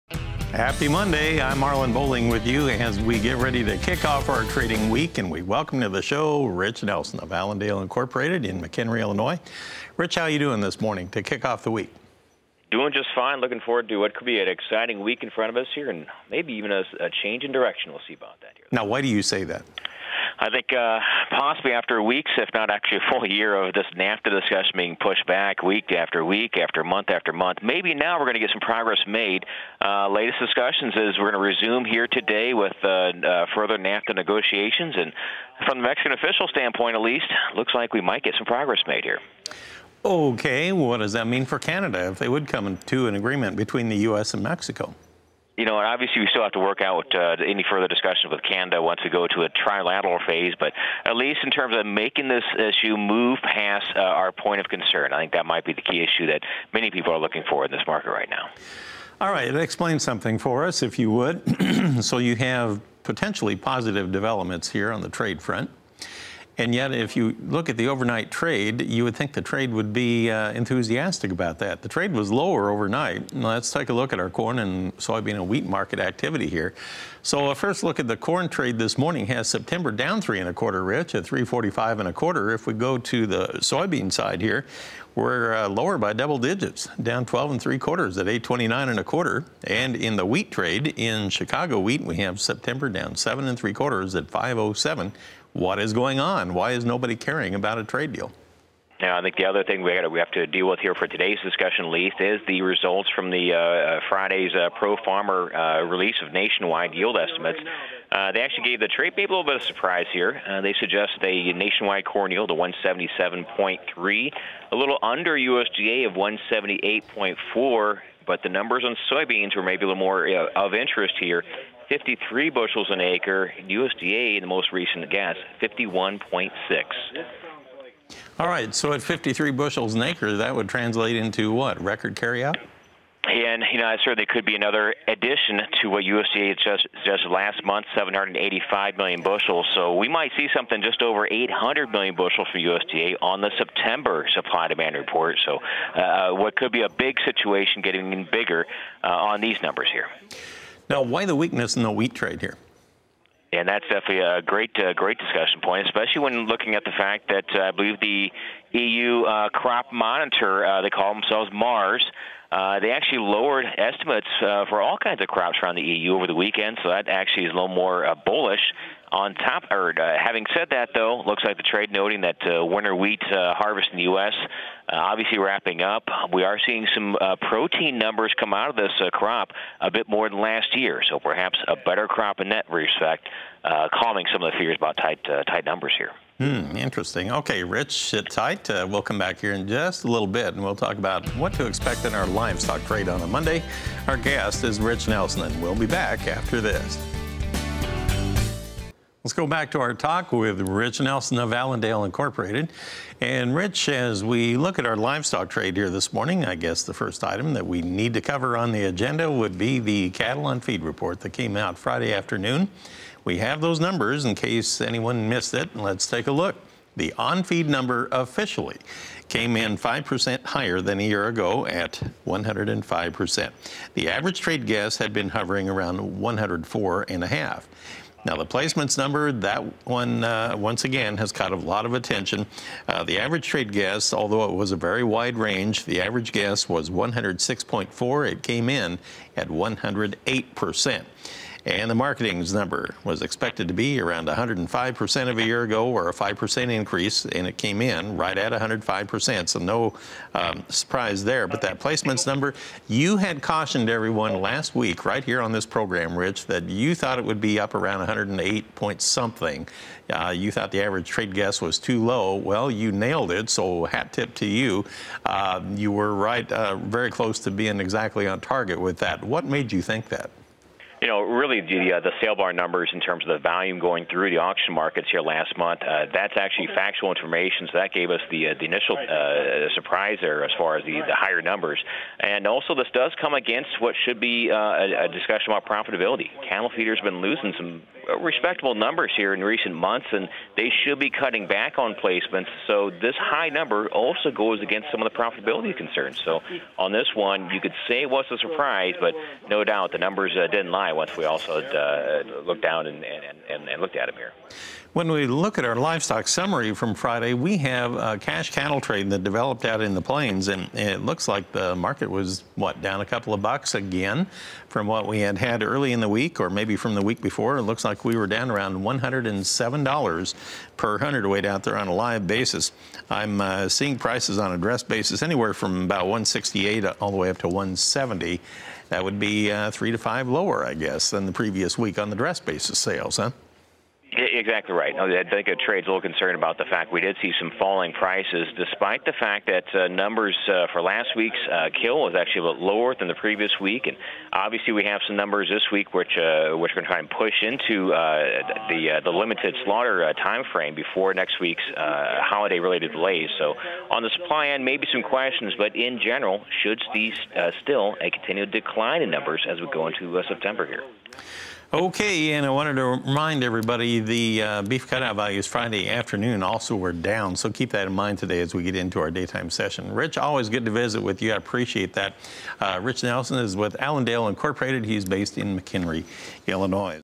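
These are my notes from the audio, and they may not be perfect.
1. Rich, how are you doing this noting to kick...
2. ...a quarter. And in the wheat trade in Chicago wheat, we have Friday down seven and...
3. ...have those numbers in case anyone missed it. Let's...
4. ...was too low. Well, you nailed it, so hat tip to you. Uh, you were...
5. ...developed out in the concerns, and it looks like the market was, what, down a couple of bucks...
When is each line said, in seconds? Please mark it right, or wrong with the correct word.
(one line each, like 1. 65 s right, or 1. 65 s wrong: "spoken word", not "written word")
1. 9 s wrong: "morning", not "noting"
2. 88 s wrong: "September", not "Friday"
3. 213 s right
4. 261 s right
5. 309 s wrong: "plains", not "concerns".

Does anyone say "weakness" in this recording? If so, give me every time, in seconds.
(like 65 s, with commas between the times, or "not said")
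151 s.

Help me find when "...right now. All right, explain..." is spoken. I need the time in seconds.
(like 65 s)
58 s.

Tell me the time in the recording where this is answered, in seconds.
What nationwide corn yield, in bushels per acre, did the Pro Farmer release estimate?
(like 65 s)
112 s.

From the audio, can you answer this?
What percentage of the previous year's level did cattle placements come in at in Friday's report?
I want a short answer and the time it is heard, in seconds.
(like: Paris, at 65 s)
108%, at 238 s.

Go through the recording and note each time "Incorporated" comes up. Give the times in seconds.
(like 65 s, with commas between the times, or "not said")
7 s, 202 s, 374 s.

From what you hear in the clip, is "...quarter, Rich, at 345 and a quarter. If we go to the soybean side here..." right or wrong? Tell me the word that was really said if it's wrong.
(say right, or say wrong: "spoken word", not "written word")
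right.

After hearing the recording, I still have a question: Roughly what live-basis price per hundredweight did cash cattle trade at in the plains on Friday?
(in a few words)
$107.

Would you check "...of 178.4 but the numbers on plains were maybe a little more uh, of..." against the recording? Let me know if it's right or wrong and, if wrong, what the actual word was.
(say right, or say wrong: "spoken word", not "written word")
wrong: "soybeans", not "plains".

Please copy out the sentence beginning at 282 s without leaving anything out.
And also, this does come against what should be uh, a, a, discussion about profitability.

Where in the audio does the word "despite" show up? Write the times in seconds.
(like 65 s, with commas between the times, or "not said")
338 s.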